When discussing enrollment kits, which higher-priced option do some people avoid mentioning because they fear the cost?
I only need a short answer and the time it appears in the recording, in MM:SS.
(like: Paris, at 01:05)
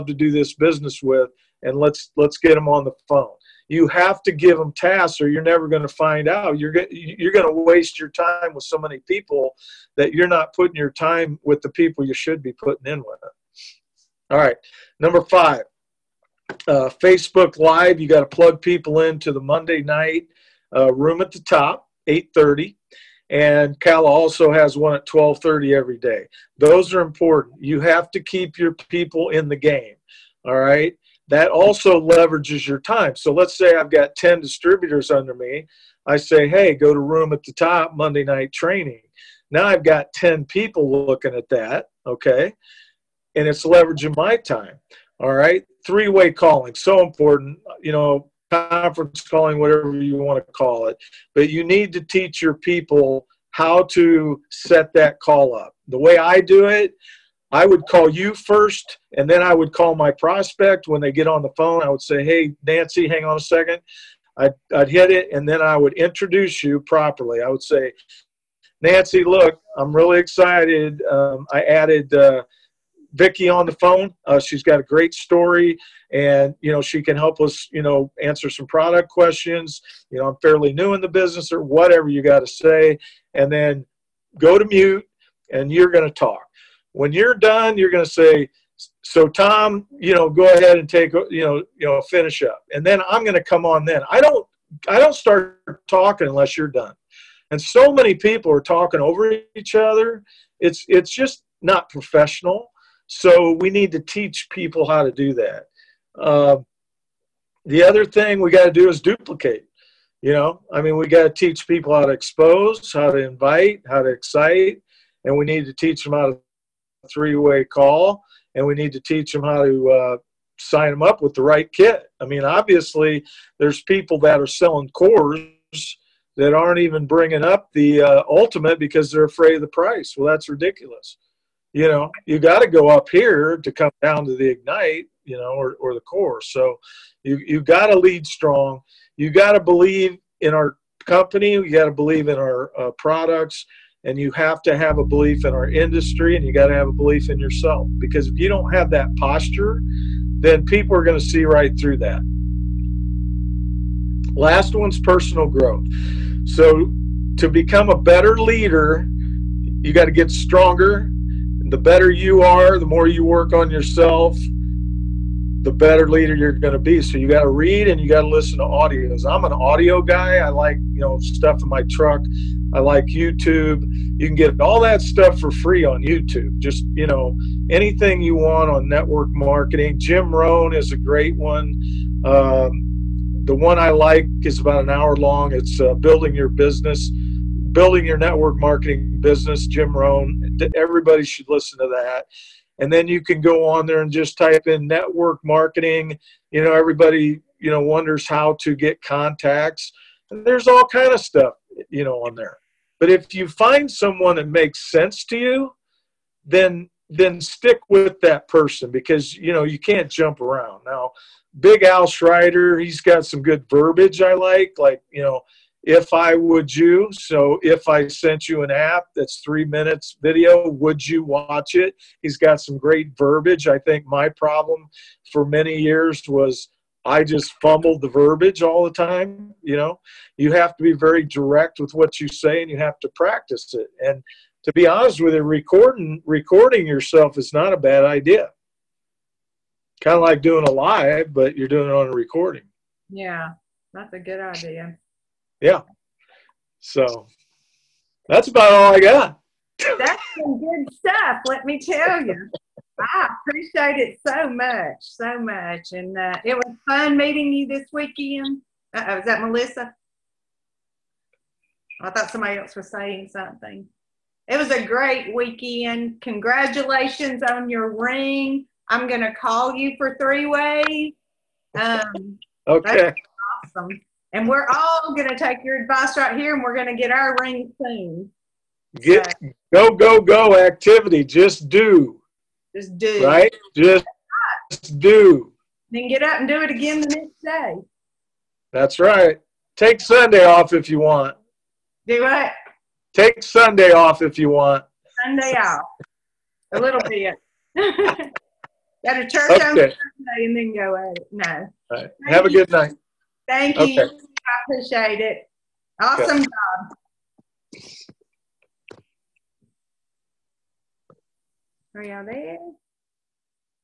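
ultimate, at 02:08.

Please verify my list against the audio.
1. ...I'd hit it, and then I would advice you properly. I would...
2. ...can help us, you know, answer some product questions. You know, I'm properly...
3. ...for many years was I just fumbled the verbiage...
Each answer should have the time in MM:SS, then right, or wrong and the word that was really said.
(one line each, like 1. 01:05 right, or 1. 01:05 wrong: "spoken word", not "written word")
1. 01:04 wrong: "introduce", not "advice"
2. 01:17 wrong: "fairly", not "properly"
3. 03:45 right.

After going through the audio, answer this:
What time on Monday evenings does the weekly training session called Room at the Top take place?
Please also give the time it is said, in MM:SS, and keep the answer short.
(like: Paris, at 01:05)
8:30, at 00:22.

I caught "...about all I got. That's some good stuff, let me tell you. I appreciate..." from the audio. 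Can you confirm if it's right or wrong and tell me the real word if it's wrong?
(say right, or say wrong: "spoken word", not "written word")
right.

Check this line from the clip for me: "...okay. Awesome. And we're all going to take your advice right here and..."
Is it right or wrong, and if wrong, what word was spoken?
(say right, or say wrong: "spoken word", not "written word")
right.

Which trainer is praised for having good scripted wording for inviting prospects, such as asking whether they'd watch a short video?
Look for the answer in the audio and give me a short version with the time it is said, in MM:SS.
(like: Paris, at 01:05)
Big Al Schreiter, at 03:31.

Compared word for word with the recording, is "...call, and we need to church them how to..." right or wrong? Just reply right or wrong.
wrong.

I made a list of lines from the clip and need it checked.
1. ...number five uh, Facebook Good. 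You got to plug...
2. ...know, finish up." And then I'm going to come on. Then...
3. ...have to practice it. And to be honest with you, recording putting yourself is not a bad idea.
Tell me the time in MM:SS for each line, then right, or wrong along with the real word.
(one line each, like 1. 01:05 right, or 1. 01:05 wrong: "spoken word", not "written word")
1. 00:14 wrong: "Live", not "Good"
2. 01:31 right
3. 03:52 wrong: "recording", not "putting".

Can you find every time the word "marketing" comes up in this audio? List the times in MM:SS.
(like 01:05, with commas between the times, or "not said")
02:59, 03:08, 03:15.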